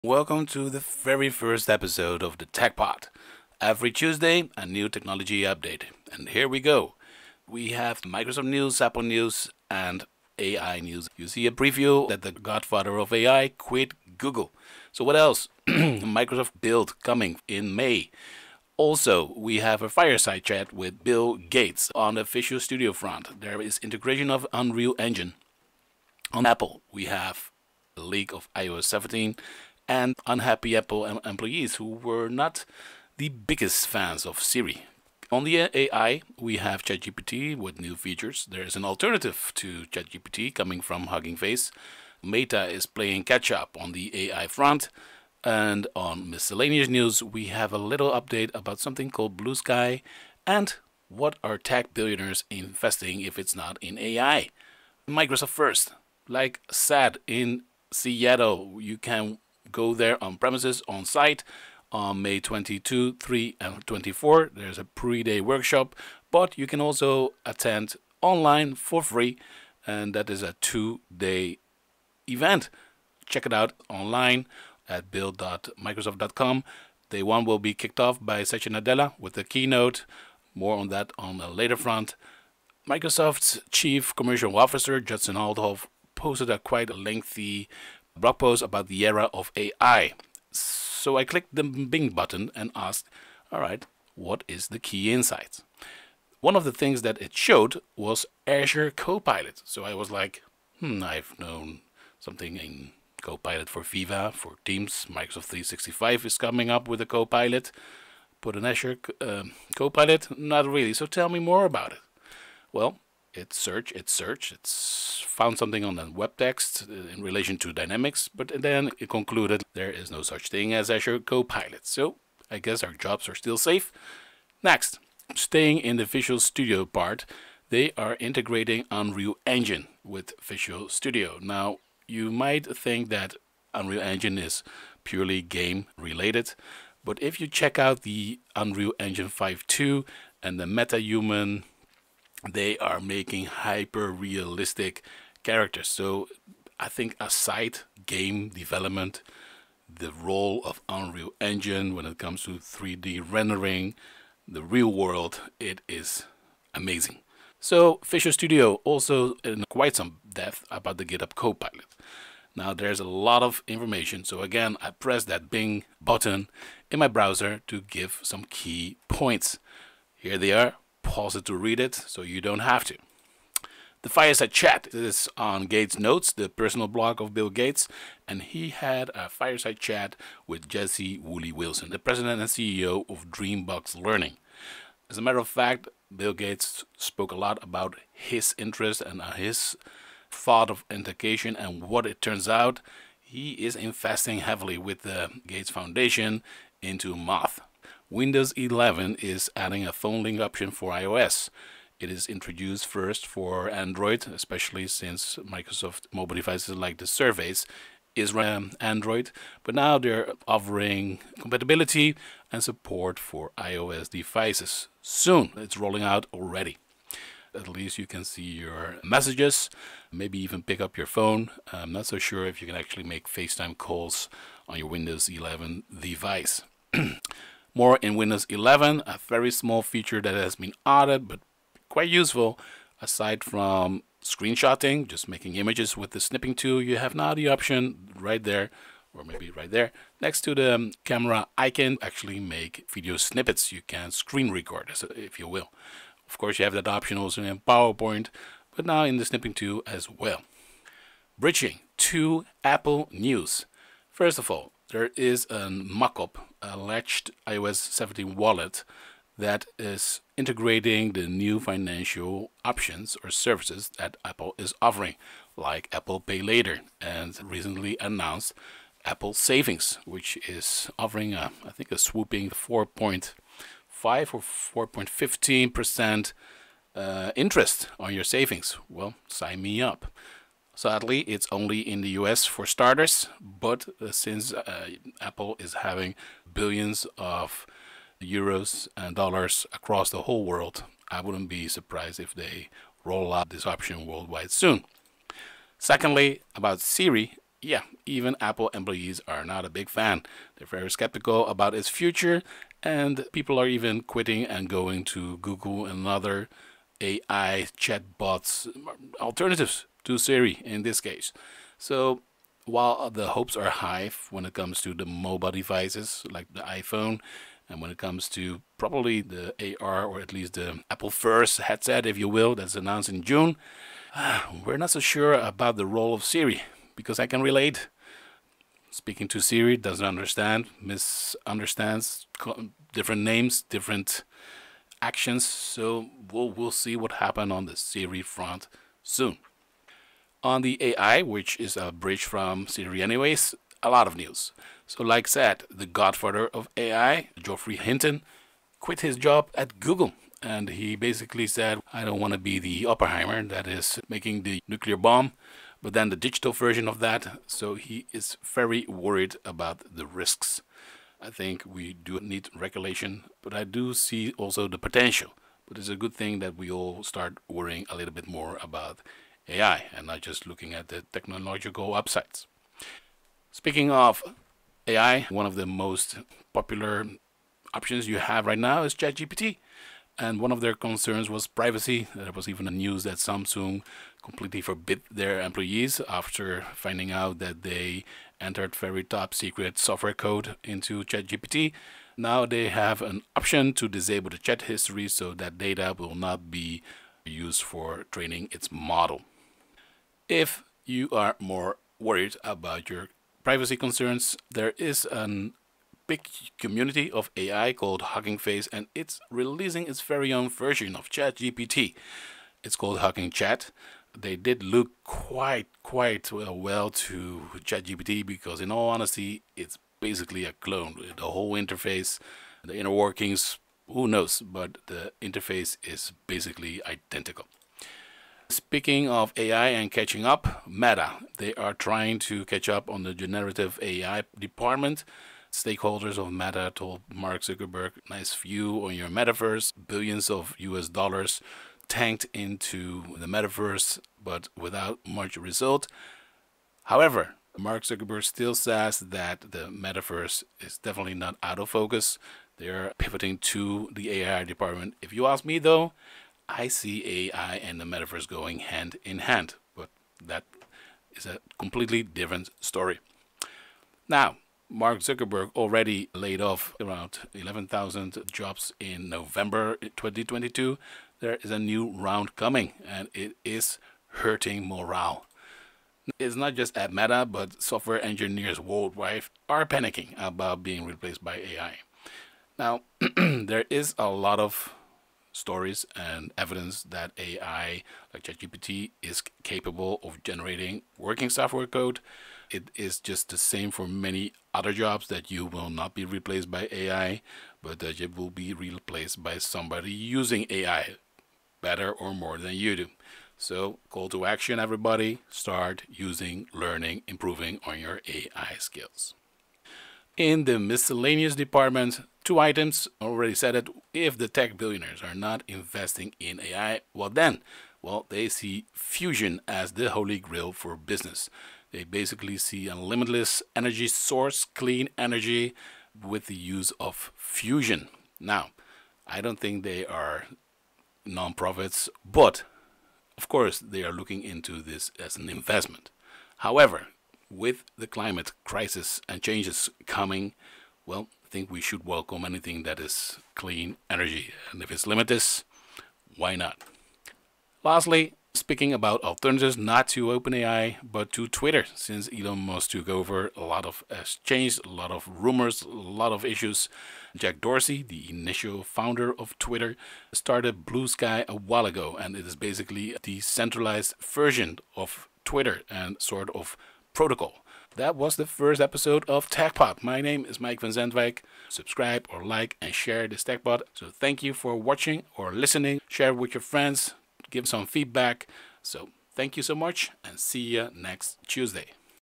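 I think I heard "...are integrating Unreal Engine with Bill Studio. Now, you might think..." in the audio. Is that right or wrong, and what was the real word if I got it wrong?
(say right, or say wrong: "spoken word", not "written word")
wrong: "Visual", not "Bill".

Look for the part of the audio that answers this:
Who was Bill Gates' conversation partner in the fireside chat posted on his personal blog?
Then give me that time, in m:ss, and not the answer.
3:00.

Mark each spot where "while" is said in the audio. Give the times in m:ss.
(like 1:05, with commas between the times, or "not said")
5:12, 9:21.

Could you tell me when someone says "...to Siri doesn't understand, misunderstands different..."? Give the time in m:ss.
5:29.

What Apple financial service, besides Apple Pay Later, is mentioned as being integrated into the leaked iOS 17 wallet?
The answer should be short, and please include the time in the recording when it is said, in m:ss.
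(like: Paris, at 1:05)
Apple Savings, at 4:29.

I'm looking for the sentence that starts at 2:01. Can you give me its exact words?
So I guess our jobs are still safe.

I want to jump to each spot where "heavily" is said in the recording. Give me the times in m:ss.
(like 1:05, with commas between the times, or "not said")
3:14.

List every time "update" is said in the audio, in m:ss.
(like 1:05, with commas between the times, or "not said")
0:05, 0:48.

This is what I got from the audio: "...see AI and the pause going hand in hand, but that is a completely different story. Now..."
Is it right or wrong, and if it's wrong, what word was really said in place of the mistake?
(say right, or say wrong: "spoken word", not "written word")
wrong: "metaverse", not "pause".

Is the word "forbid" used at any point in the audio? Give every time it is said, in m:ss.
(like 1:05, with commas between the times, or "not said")
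6:24.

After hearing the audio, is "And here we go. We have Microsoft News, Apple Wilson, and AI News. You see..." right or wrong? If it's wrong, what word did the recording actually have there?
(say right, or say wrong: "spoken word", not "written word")
wrong: "News", not "Wilson".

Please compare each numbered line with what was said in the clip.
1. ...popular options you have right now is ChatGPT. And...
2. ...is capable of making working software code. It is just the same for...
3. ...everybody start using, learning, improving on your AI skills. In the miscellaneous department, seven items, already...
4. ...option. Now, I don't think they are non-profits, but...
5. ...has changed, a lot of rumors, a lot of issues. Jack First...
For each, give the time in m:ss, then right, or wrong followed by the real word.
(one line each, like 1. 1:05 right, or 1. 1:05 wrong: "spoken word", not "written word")
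1. 6:16 right
2. 8:09 wrong: "generating", not "making"
3. 8:24 wrong: "two", not "seven"
4. 8:47 wrong: "fusion", not "option"
5. 9:13 wrong: "Dorsey", not "First".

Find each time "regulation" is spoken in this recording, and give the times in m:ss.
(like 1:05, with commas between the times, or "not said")
6:02.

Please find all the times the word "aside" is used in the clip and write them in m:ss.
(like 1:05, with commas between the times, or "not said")
2:27, 3:53.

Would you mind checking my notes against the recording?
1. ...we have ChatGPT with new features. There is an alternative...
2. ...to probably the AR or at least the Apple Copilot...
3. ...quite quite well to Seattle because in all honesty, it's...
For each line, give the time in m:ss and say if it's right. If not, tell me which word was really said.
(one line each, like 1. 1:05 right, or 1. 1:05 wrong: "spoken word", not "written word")
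1. 0:36 right
2. 5:18 wrong: "First", not "Copilot"
3. 6:55 wrong: "ChatGPT", not "Seattle".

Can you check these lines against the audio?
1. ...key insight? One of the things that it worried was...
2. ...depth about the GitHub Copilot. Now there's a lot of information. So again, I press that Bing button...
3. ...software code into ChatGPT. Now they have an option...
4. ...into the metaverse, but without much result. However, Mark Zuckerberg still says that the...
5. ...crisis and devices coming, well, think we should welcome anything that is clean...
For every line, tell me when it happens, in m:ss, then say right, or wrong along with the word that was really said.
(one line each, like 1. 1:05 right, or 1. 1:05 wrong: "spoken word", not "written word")
1. 1:34 wrong: "showed", not "worried"
2. 2:40 right
3. 6:29 right
4. 7:22 right
5. 8:58 wrong: "changes", not "devices".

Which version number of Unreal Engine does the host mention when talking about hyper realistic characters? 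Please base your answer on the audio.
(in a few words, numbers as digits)
5.2.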